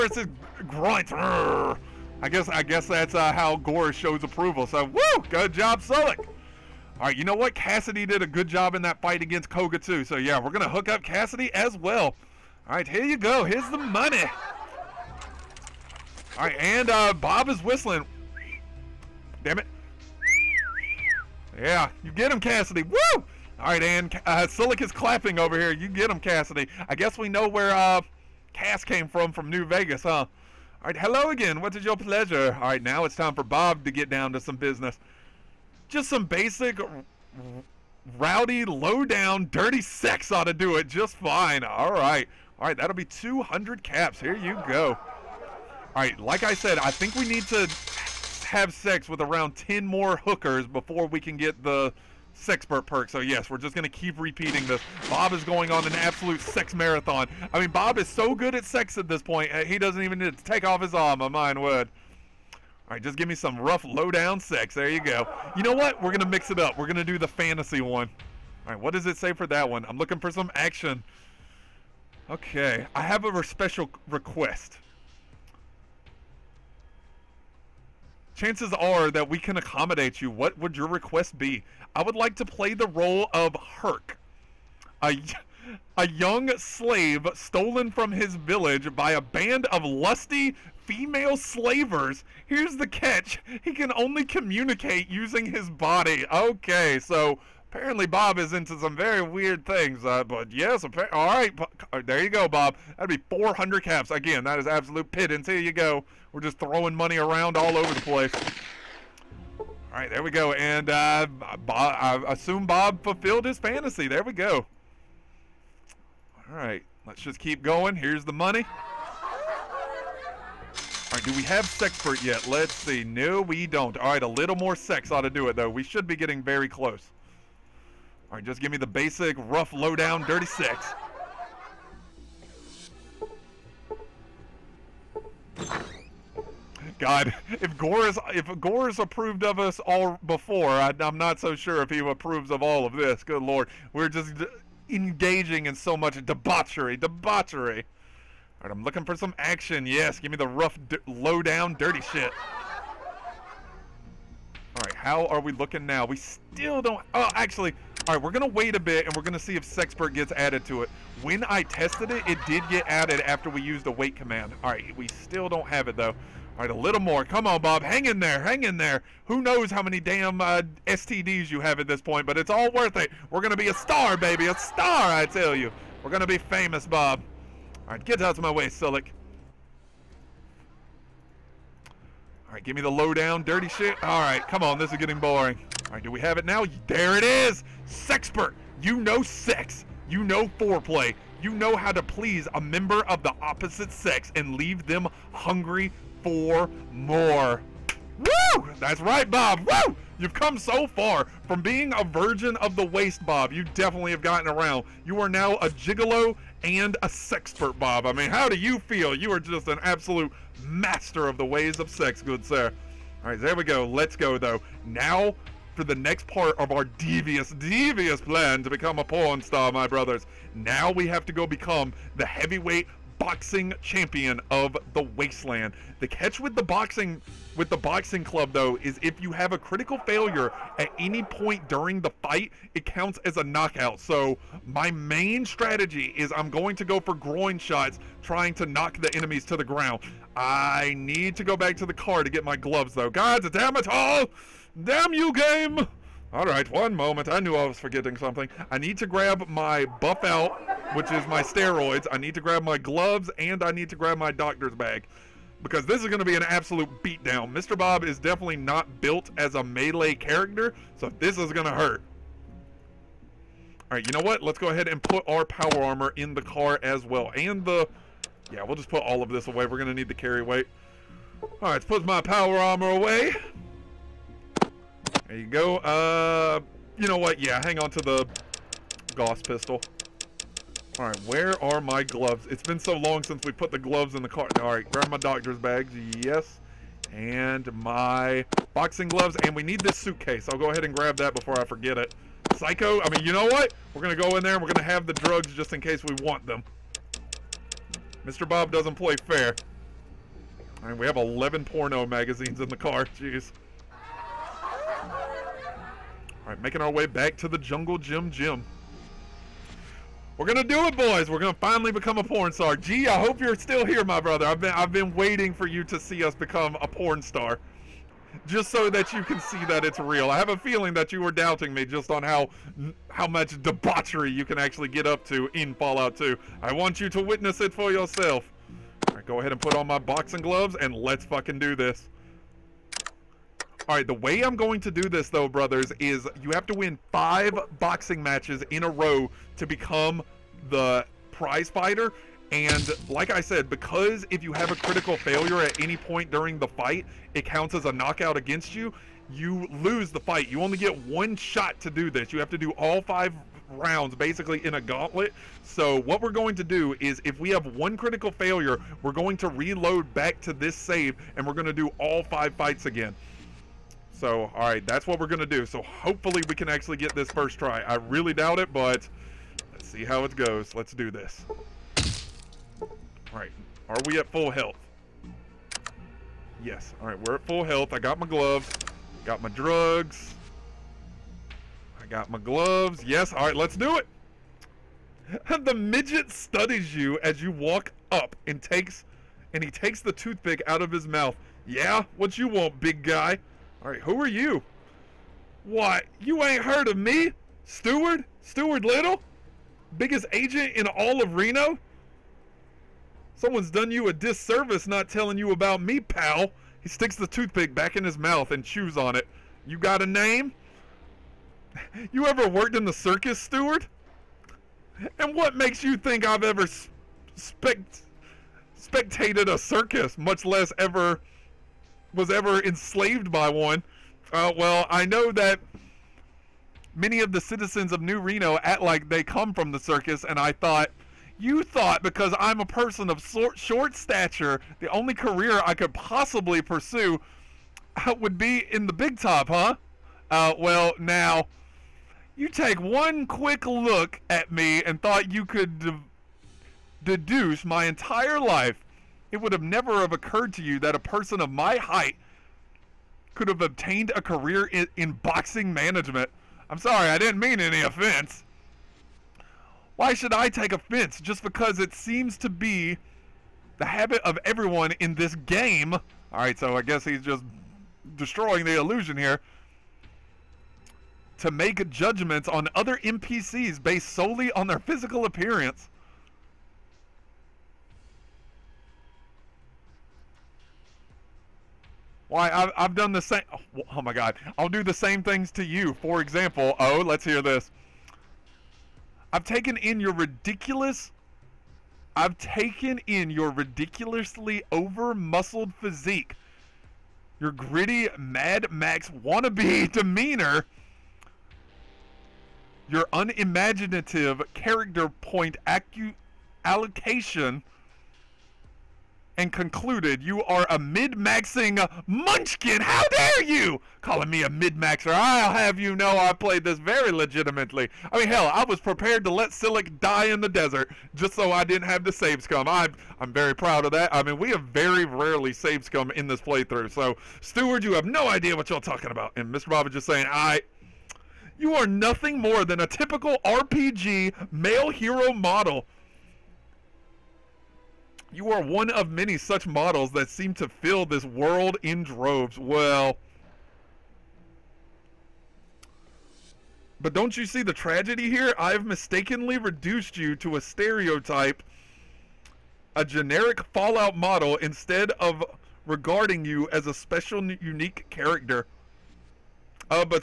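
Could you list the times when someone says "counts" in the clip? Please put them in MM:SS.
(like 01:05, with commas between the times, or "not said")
03:52, 05:47.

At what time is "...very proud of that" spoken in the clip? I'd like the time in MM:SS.
08:43.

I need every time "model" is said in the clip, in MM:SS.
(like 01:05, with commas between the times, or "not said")
08:55, 08:59, 09:14.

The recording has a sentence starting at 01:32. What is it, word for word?
Here's the catch he can only communicate using his body.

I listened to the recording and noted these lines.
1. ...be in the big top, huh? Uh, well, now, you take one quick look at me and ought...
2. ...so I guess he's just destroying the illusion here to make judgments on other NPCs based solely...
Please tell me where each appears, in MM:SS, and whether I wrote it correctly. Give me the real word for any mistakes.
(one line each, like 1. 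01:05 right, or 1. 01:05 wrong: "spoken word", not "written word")
1. 07:18 wrong: "thought", not "ought"
2. 07:46 right.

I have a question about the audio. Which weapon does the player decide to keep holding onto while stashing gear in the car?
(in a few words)
Gauss pistol.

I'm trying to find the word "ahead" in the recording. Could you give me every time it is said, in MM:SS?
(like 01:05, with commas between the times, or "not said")
04:24, 04:50, 05:29.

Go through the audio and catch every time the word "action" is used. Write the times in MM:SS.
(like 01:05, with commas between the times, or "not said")
01:10, 02:29.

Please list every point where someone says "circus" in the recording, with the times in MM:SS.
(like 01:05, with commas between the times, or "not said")
06:52, 06:59, 07:09.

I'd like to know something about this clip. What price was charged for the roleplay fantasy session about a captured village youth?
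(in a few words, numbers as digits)
400 caps.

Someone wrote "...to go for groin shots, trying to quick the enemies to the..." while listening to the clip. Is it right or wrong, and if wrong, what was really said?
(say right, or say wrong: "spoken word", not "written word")
wrong: "knock", not "quick".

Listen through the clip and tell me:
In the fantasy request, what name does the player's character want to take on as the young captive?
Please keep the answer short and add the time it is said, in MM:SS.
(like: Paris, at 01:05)
Herc, at 01:23.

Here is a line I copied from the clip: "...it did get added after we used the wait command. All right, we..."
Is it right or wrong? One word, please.
right.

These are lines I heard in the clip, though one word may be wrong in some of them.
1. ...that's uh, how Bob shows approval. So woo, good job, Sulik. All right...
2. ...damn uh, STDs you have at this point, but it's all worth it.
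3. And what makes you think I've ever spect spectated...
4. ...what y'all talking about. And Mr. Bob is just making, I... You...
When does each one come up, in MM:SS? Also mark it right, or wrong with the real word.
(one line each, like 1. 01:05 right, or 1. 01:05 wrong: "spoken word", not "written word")
1. 00:02 wrong: "Gore", not "Bob"
2. 02:49 right
3. 06:55 right
4. 08:48 wrong: "saying", not "making".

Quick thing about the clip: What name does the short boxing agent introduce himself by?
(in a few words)
Stuart Little.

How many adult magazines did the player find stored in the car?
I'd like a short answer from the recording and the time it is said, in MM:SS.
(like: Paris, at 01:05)
11, at 05:01.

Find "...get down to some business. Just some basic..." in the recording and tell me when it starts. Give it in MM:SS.
00:33.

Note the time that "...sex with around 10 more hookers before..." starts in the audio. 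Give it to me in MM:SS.
00:48.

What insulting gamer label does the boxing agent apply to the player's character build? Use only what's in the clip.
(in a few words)
min-maxing munchkin.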